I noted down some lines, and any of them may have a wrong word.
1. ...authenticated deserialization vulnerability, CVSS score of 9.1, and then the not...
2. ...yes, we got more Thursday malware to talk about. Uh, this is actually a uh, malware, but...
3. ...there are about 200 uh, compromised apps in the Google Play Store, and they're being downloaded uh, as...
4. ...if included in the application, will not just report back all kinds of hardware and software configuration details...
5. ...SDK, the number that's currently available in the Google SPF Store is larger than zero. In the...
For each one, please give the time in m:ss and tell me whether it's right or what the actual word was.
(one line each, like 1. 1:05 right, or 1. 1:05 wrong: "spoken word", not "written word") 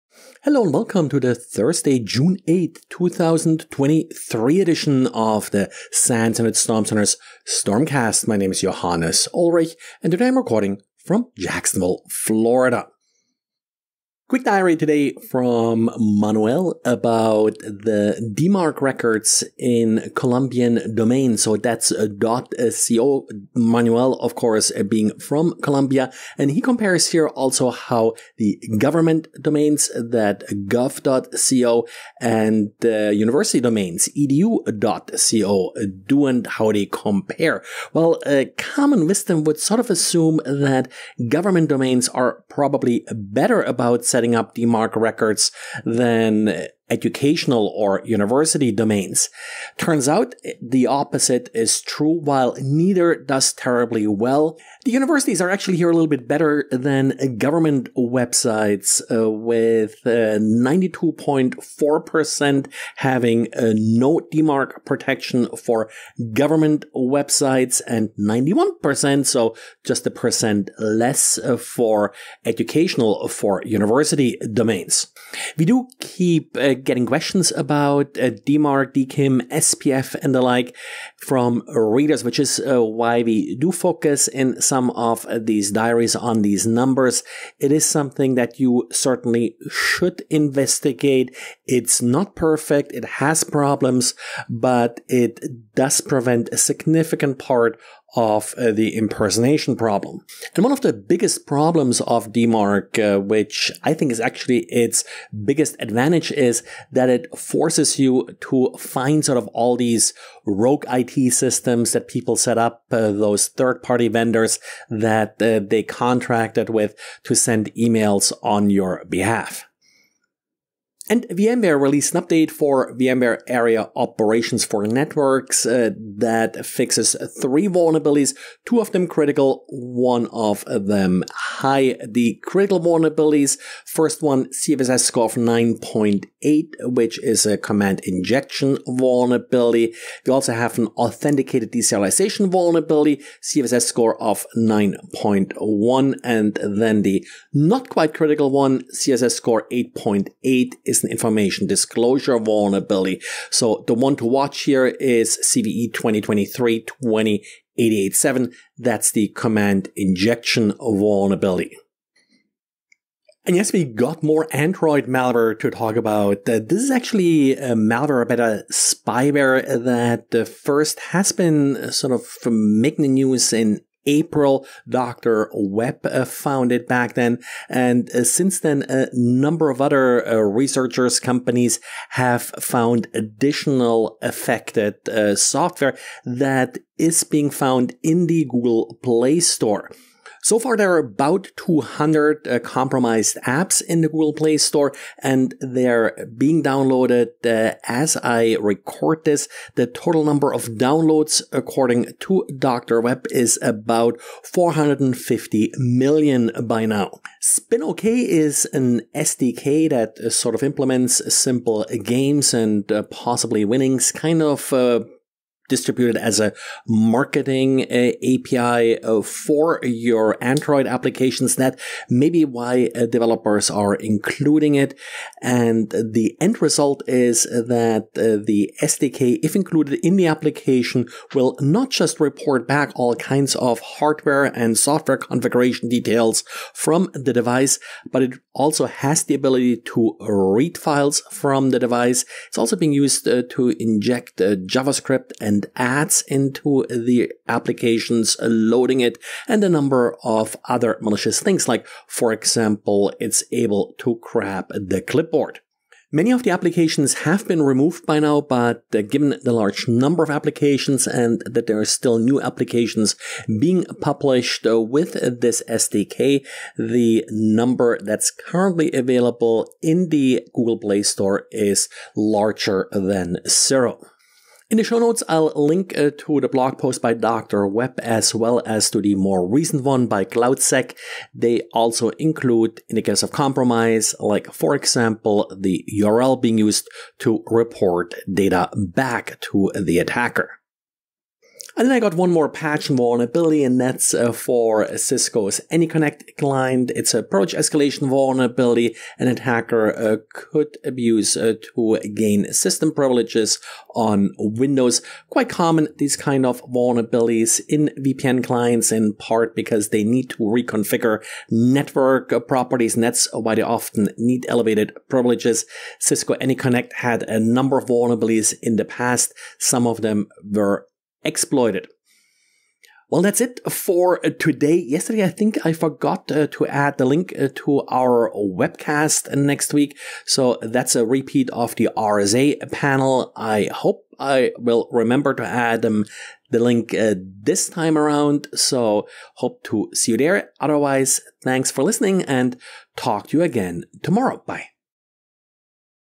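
1. 2:20 right
2. 2:43 wrong: "Android", not "Thursday"
3. 3:10 right
4. 3:49 right
5. 4:25 wrong: "Play", not "SPF".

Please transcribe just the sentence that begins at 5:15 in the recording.
Cisco AnyConnect had a number of vulnerabilities in the past.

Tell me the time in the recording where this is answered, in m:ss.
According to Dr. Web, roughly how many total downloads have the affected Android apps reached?
3:24.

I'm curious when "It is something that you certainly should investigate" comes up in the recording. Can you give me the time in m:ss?
1:27.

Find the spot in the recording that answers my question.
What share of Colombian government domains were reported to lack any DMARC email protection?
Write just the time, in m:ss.
1:00.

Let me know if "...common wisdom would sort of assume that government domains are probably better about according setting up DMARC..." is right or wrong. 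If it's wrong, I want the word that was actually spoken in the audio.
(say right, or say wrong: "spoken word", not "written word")
wrong: "setting", not "according".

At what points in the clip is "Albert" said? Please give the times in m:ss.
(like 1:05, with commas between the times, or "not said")
not said.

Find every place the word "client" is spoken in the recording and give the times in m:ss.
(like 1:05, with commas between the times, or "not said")
4:56, 5:08.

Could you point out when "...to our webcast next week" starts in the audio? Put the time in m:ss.
5:27.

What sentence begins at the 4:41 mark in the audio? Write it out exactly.
They also include, in the case of compromise, like for example, the URL being used to report data back to the attacker.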